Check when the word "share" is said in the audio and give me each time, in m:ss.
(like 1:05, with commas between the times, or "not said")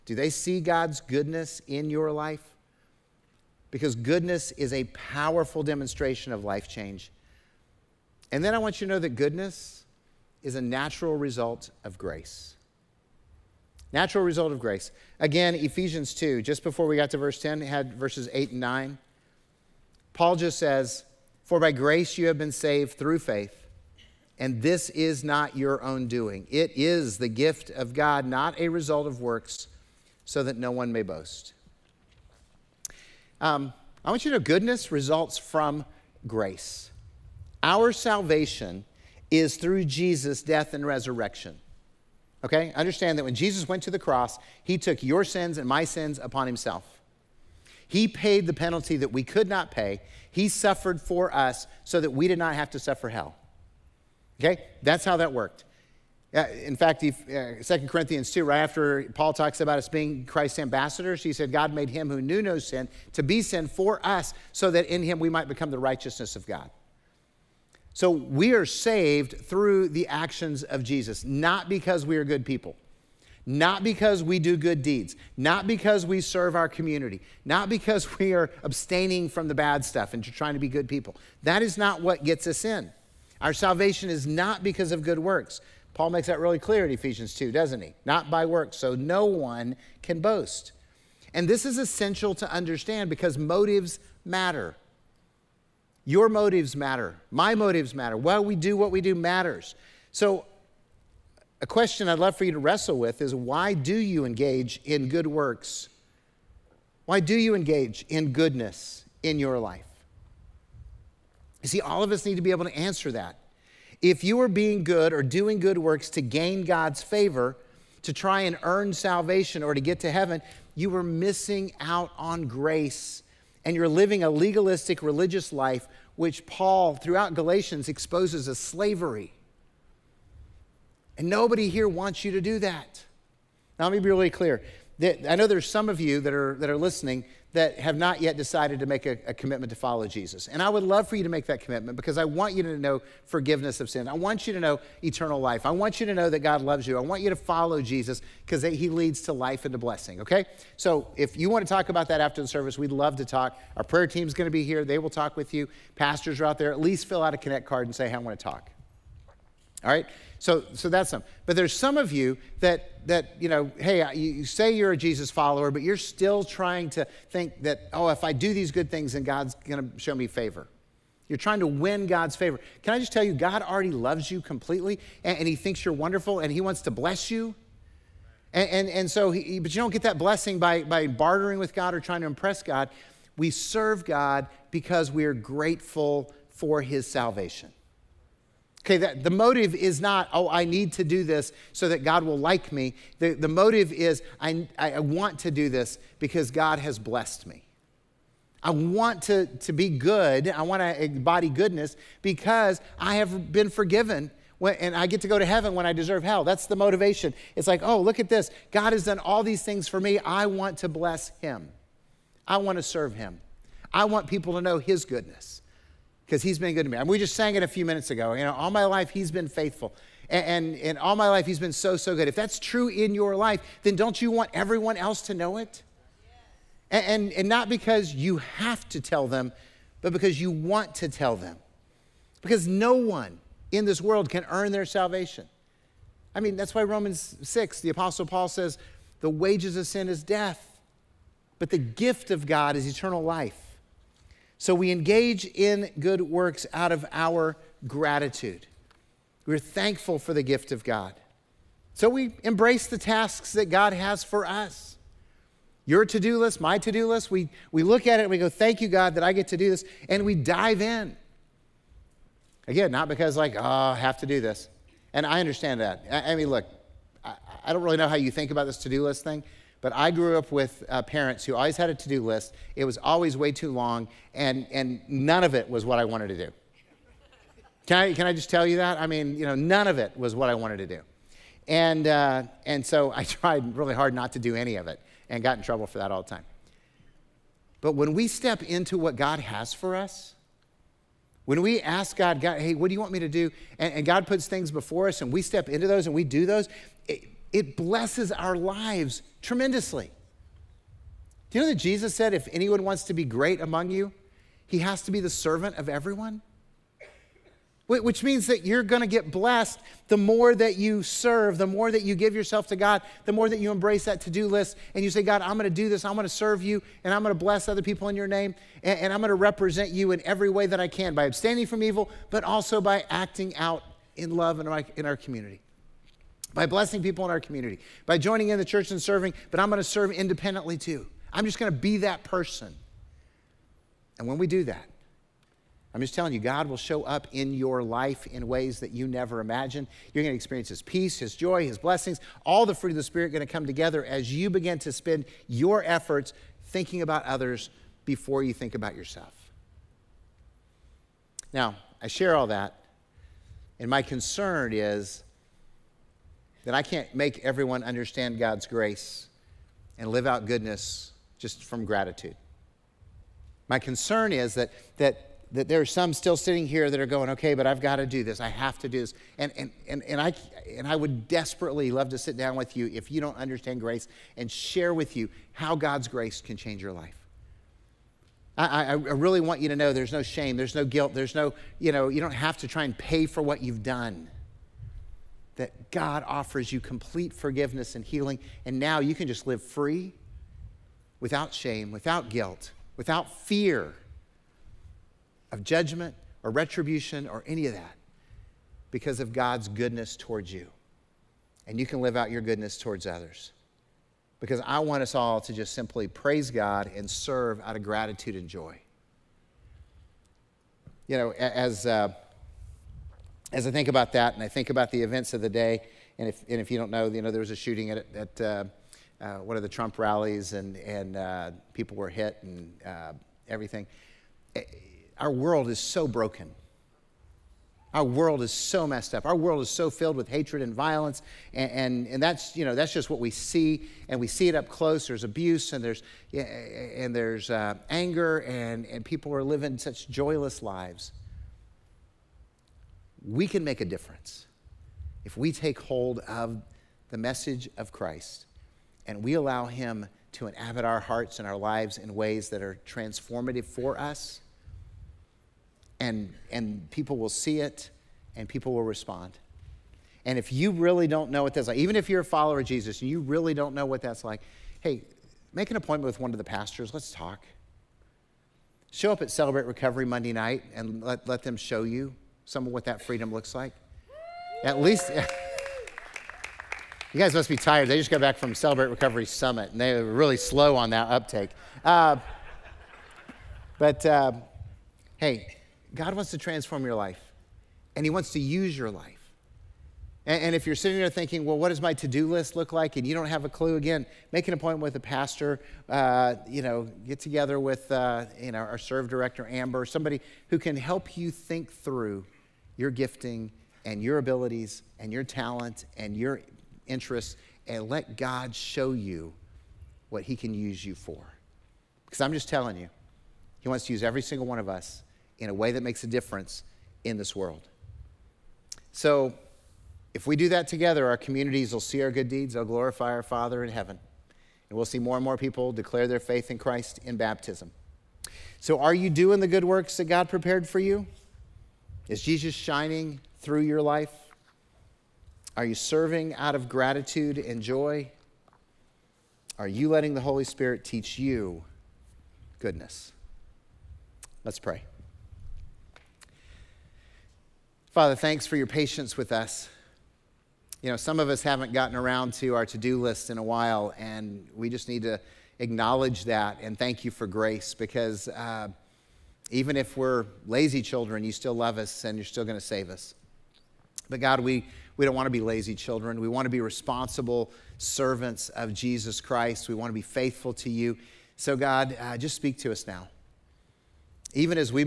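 5:52, 6:14.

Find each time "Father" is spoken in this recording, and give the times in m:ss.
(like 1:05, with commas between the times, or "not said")
8:43, 9:07.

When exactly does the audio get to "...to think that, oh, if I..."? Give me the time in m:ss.
2:46.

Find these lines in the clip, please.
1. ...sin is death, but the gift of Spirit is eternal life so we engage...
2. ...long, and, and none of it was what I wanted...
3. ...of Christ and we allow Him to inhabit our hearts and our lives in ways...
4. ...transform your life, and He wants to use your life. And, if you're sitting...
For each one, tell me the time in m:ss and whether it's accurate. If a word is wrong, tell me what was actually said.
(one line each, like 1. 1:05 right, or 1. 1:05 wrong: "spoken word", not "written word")
1. 3:59 wrong: "God", not "Spirit"
2. 4:33 right
3. 7:27 right
4. 8:06 right.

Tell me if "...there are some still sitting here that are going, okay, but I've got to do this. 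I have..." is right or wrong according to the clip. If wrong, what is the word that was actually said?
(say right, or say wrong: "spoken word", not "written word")
right.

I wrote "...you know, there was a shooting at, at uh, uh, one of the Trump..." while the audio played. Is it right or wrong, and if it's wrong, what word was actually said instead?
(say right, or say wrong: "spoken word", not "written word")
right.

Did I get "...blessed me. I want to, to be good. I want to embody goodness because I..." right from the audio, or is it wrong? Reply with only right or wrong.
right.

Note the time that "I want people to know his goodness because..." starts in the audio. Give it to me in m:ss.
3:33.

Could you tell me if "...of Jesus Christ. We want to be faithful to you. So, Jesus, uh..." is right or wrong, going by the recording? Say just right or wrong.
wrong.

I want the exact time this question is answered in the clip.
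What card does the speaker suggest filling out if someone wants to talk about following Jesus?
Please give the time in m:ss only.
2:37.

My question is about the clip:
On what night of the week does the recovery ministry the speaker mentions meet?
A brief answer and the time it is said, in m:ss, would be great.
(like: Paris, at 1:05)
Monday, at 7:50.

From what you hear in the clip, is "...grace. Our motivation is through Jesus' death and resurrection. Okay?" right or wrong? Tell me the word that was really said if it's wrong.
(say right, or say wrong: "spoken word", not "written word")
wrong: "salvation", not "motivation".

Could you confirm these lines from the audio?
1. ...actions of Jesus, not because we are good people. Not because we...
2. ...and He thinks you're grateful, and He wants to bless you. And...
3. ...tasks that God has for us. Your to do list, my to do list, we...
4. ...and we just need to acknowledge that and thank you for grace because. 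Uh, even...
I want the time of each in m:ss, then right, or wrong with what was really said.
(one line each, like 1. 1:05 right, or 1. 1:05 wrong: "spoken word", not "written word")
1. 1:10 right
2. 2:55 wrong: "wonderful", not "grateful"
3. 4:12 right
4. 9:13 right.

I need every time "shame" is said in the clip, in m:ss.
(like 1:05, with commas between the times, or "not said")
6:20, 6:31.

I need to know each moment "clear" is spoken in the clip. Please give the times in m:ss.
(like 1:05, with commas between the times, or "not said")
1:26, 2:14.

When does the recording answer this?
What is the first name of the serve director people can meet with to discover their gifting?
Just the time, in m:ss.
8:19.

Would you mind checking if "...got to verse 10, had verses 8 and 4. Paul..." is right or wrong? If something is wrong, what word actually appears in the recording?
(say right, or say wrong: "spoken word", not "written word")
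wrong: "9", not "4".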